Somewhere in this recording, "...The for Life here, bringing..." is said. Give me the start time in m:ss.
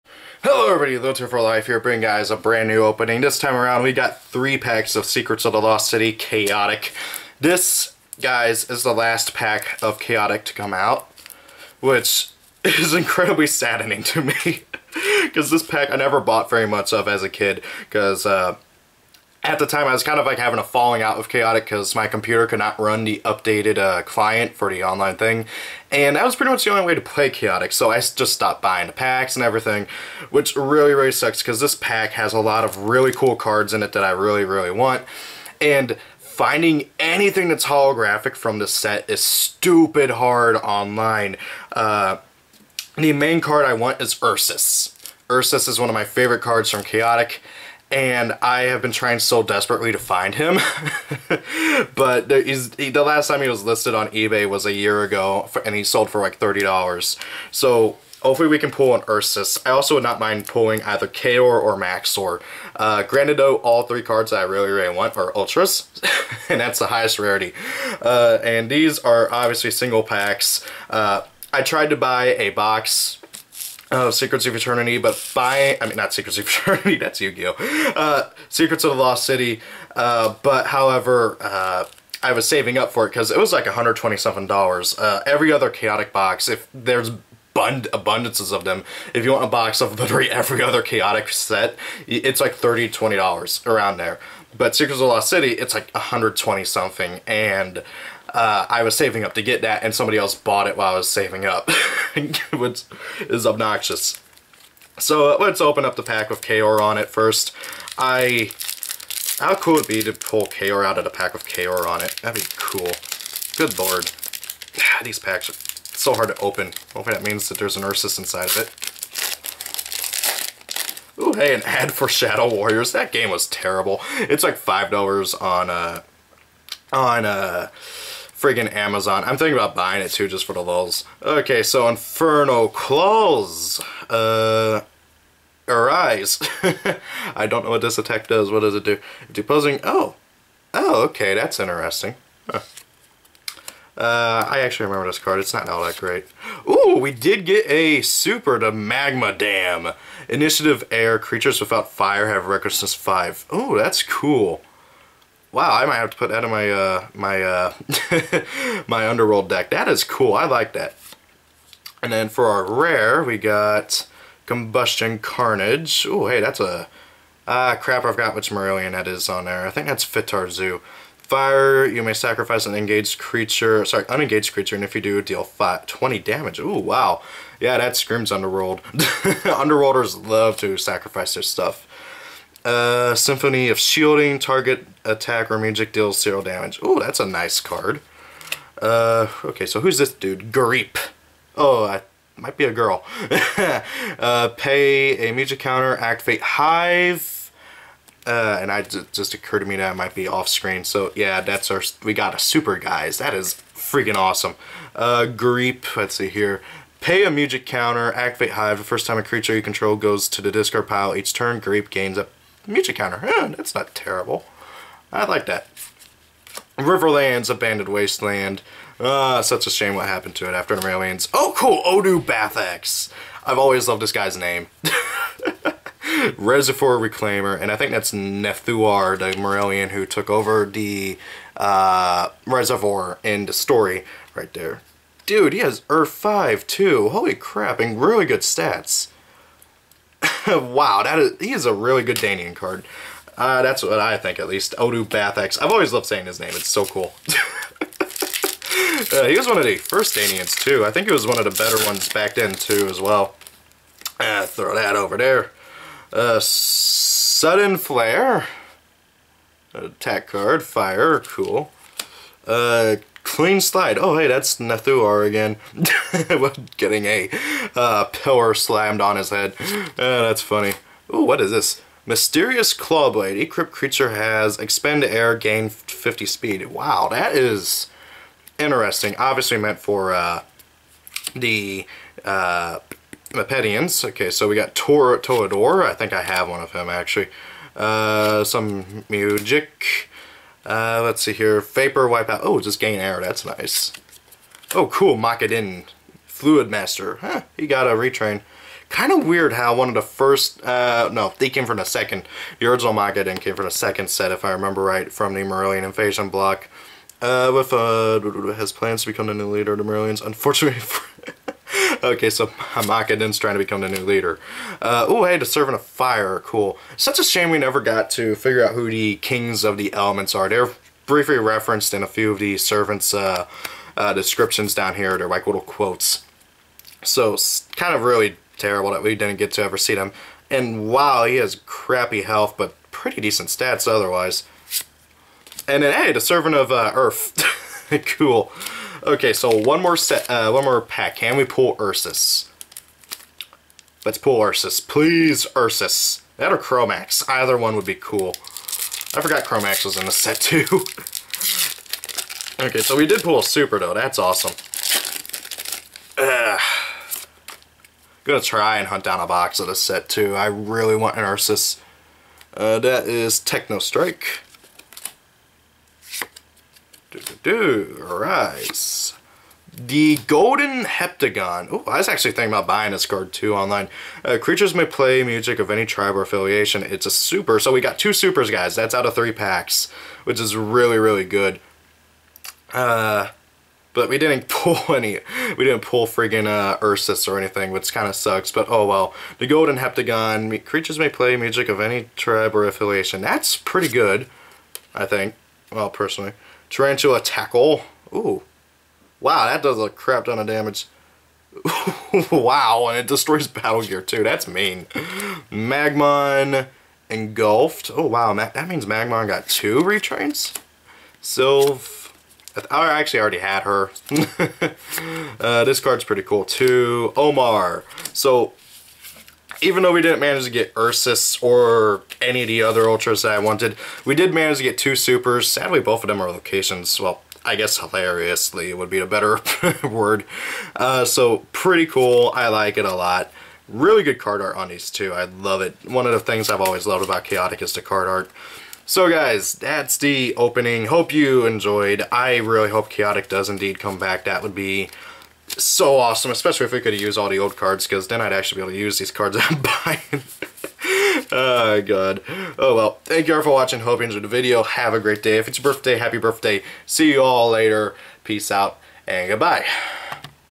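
0:01.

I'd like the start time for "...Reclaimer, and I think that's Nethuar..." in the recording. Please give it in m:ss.
3:46.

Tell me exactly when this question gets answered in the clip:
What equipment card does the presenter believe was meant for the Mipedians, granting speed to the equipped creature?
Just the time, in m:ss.
4:32.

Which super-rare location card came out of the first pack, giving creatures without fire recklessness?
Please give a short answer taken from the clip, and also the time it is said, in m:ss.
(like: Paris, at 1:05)
Magma Dam, at 2:28.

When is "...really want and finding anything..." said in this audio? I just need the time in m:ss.
0:34.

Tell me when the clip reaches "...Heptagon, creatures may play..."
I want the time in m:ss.
6:29.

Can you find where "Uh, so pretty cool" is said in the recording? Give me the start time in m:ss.
7:10.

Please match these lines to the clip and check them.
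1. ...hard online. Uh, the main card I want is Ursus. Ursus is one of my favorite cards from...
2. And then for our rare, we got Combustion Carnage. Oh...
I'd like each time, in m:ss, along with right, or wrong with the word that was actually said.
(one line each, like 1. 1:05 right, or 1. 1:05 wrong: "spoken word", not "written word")
1. 0:40 right
2. 2:42 right.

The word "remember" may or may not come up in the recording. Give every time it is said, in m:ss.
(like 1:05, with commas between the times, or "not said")
2:24, 5:04.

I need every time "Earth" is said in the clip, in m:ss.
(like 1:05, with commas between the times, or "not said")
3:55, 5:36.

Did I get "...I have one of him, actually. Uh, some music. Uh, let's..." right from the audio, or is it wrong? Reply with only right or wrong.
right.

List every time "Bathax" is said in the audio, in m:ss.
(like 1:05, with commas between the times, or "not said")
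3:42, 4:05.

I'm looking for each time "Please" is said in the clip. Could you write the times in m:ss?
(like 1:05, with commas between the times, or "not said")
5:44.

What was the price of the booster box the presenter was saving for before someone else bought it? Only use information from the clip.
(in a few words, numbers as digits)
$127.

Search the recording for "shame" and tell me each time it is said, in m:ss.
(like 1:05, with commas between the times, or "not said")
3:39, 5:17.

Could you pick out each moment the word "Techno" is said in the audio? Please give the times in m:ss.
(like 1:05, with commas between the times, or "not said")
6:03.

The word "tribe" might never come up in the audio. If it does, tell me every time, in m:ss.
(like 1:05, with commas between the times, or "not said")
6:15, 6:32.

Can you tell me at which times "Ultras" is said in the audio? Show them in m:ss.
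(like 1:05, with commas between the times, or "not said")
1:05, 7:02.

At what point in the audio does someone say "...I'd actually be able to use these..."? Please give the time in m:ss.
7:28.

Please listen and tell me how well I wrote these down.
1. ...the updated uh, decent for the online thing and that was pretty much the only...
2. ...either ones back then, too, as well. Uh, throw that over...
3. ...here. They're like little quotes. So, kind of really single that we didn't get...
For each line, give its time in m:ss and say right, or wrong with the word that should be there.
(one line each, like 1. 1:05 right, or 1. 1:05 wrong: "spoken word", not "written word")
1. 0:23 wrong: "client", not "decent"
2. 4:11 wrong: "better", not "either"
3. 5:24 wrong: "terrible", not "single".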